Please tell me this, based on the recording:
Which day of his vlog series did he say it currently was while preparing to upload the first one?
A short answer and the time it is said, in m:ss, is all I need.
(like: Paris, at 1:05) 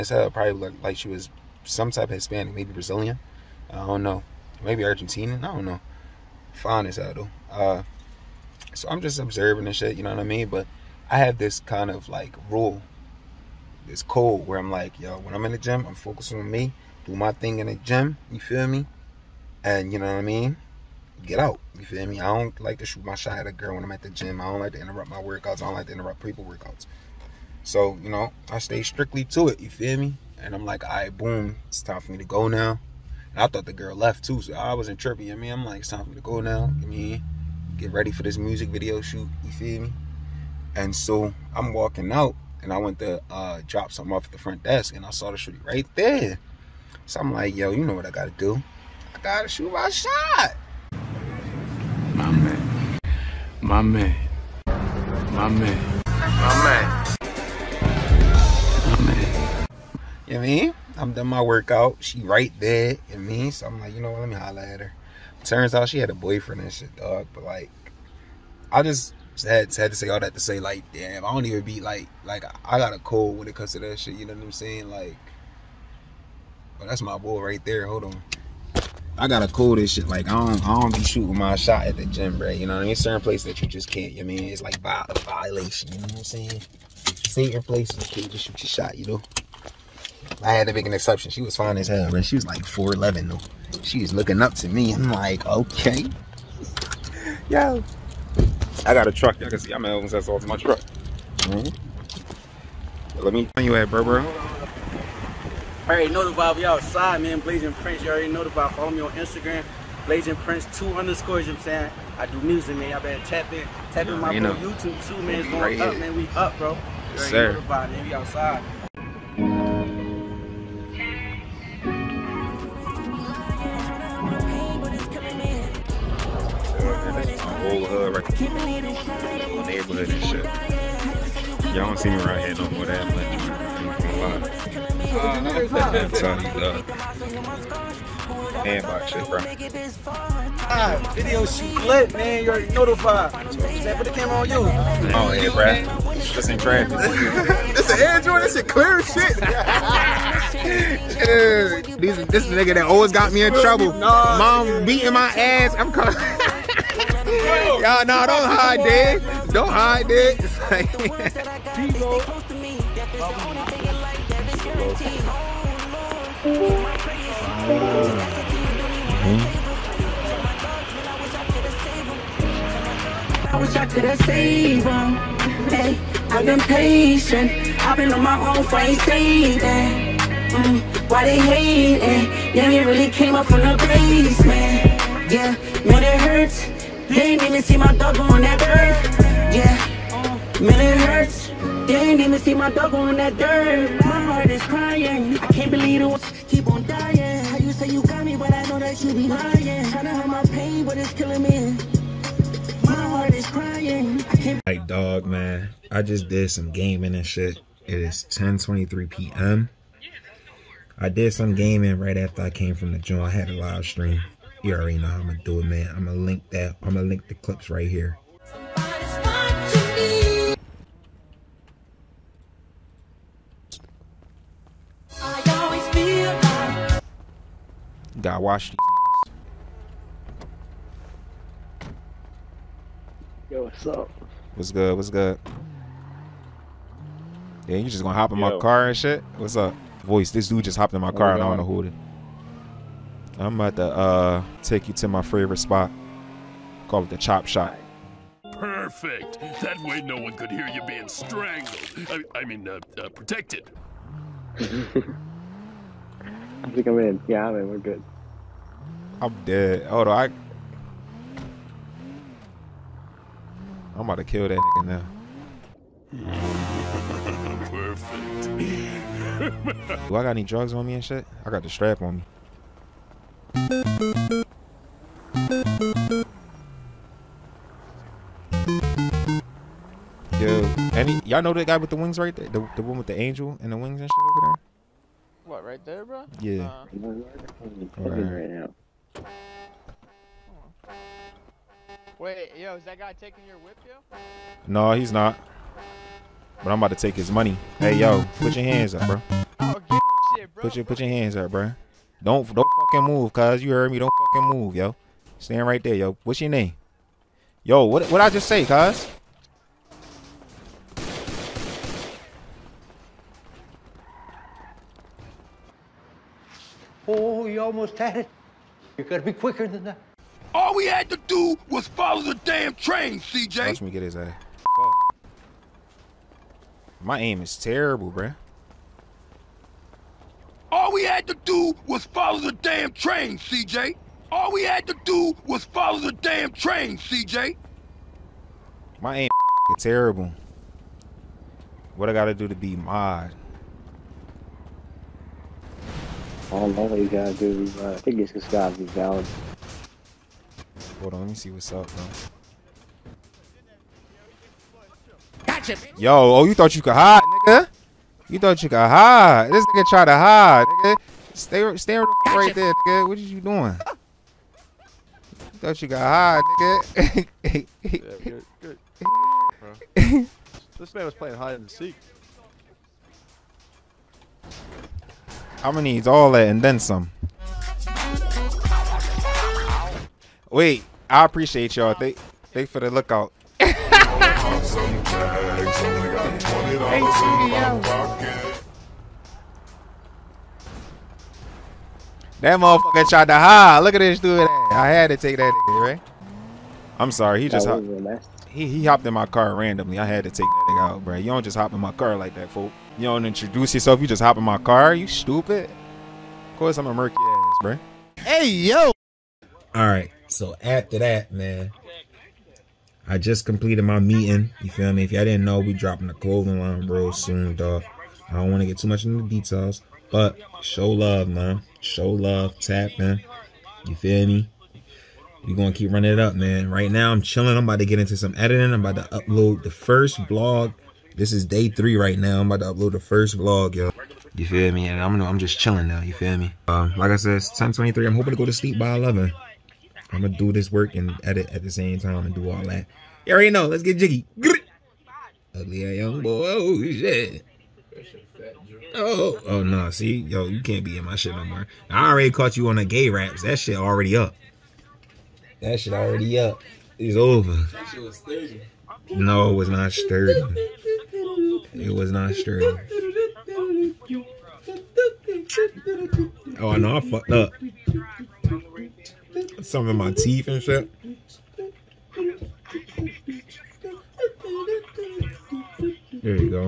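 Day 3, at 7:11.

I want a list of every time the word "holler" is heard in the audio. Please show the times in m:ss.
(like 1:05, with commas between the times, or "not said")
1:04.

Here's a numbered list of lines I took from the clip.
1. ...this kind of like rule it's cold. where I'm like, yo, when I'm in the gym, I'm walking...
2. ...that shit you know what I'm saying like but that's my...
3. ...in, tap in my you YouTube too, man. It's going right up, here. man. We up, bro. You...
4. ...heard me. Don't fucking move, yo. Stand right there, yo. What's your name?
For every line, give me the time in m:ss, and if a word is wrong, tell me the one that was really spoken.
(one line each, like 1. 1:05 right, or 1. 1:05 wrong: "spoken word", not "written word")
1. 0:11 wrong: "focusing", not "walking"
2. 1:13 right
3. 1:53 right
4. 5:03 right.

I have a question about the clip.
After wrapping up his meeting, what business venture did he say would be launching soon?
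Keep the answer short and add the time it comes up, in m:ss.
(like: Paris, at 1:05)
Clothing line, at 6:56.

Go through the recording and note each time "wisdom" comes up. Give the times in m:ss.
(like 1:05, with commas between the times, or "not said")
not said.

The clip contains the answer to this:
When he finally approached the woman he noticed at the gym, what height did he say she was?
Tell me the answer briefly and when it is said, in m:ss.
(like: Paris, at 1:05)
4'11, at 1:32.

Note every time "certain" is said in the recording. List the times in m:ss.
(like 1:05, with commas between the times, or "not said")
1:22, 1:27.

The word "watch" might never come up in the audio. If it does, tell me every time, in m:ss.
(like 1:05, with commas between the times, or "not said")
3:48, 5:23.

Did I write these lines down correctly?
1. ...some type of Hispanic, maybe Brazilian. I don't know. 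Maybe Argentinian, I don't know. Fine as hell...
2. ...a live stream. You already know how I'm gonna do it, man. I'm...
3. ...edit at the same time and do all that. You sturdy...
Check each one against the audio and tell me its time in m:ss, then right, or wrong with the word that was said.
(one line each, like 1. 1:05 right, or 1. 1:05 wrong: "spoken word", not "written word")
1. 0:01 right
2. 3:33 right
3. 7:21 wrong: "already", not "sturdy".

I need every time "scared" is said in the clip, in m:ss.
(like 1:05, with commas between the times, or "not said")
not said.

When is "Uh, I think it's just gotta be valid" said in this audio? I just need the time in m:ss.
5:47.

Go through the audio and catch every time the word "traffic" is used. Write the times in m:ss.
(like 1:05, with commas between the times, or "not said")
2:26.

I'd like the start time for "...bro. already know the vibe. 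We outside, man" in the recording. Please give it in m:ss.
1:44.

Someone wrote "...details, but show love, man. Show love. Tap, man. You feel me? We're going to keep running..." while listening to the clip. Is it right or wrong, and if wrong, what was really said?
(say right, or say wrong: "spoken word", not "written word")
right.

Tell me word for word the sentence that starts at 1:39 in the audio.
Y'all can see I'm almost that's all to my truck.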